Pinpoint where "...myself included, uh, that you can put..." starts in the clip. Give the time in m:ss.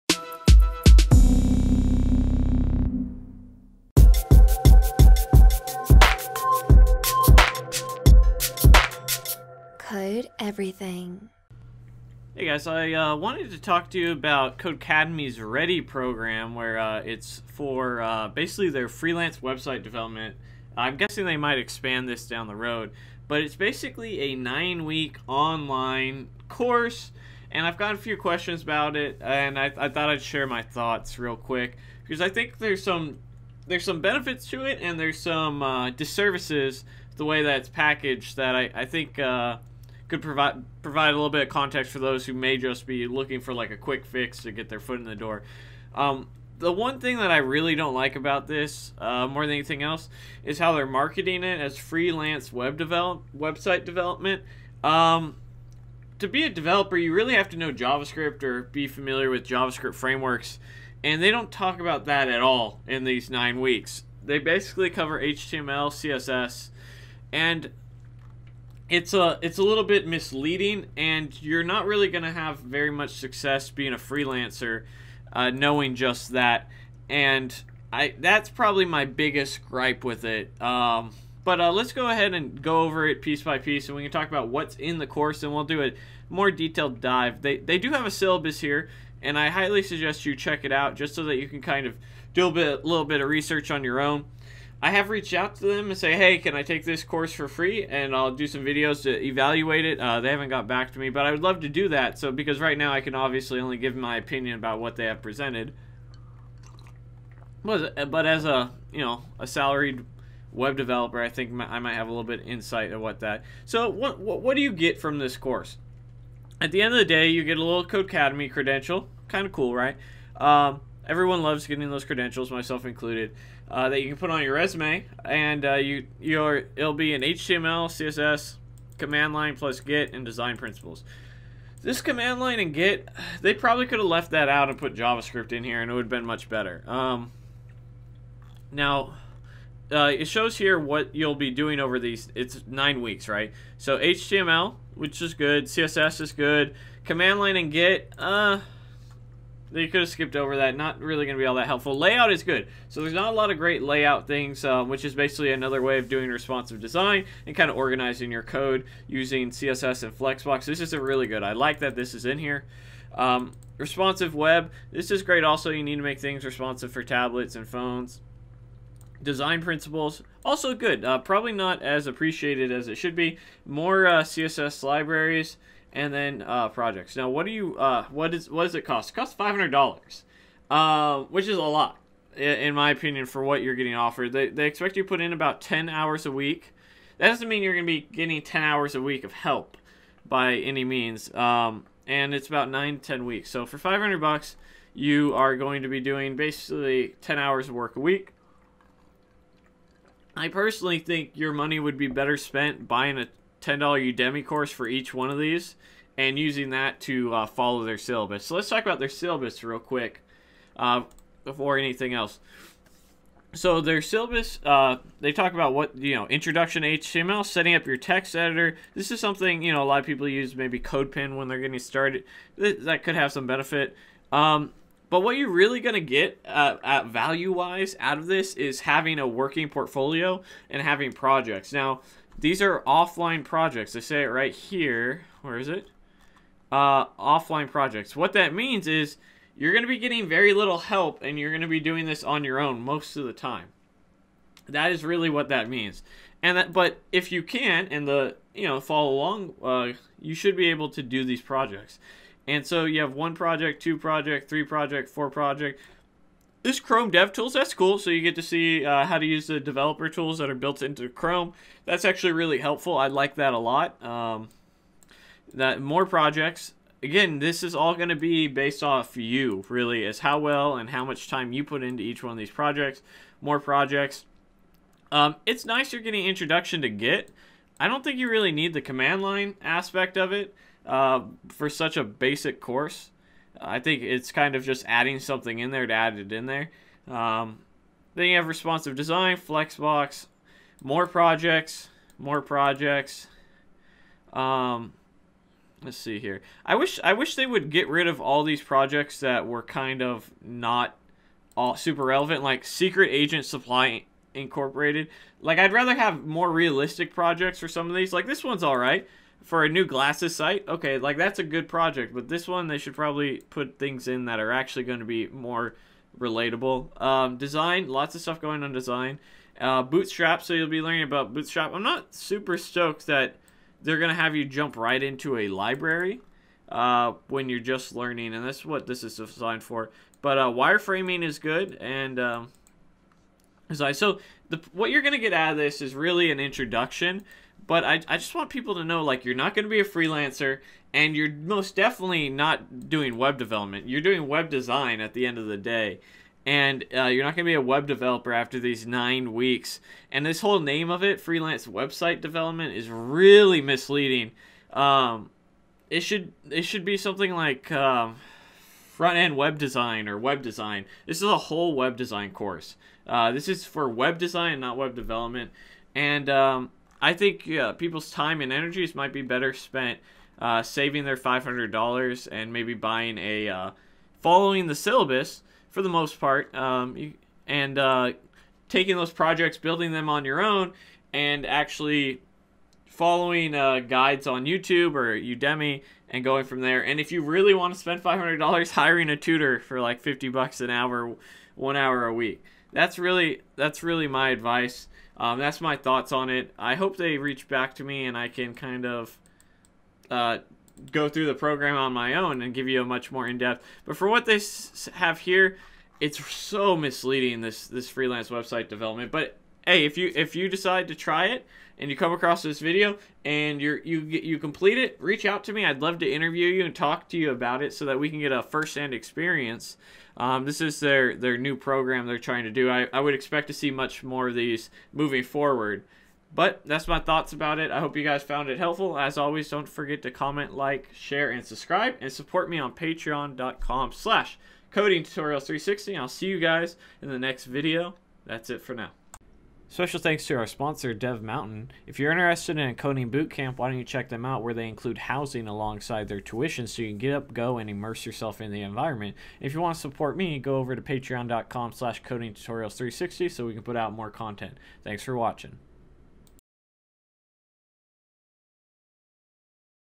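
2:02.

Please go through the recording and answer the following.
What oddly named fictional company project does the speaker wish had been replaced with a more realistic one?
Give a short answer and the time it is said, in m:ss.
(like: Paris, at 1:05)
Secret Agent Supply Incorporated, at 5:02.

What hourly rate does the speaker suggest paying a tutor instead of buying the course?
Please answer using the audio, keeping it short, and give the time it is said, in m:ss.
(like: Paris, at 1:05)
$50, at 6:30.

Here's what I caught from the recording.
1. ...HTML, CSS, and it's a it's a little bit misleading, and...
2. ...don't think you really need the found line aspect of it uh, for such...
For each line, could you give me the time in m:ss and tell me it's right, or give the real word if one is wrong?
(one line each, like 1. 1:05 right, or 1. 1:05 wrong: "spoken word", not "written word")
1. 1:05 right
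2. 4:37 wrong: "command", not "found".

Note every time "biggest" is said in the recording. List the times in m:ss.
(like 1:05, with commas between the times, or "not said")
1:19.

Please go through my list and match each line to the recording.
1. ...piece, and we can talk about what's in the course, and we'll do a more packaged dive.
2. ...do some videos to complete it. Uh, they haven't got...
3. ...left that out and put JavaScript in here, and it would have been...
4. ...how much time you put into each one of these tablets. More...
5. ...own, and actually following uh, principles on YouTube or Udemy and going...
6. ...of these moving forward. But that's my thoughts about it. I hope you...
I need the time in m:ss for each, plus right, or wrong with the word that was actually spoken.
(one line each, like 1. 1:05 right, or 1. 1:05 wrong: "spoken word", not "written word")
1. 1:23 wrong: "detailed", not "packaged"
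2. 1:38 wrong: "evaluate", not "complete"
3. 2:14 right
4. 4:30 wrong: "projects", not "tablets"
5. 6:20 wrong: "guides", not "principles"
6. 7:04 right.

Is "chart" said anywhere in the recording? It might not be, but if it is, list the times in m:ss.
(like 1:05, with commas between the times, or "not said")
not said.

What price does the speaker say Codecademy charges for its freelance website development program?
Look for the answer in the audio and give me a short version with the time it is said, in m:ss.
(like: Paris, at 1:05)
$500, at 2:59.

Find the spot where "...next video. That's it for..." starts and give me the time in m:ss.
7:17.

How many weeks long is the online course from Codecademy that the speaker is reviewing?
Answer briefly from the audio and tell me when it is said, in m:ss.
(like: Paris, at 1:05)
9, at 0:24.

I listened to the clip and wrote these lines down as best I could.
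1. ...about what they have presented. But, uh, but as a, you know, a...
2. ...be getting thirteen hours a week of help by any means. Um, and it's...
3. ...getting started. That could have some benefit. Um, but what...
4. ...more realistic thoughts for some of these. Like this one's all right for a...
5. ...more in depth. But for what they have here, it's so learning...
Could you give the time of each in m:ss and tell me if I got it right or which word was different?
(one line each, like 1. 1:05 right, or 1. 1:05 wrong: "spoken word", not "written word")
1. 1:44 right
2. 3:07 wrong: "ten", not "thirteen"
3. 3:41 right
4. 5:06 wrong: "projects", not "thoughts"
5. 6:43 wrong: "misleading", not "learning".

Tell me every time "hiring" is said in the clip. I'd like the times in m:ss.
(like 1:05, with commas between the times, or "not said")
6:28.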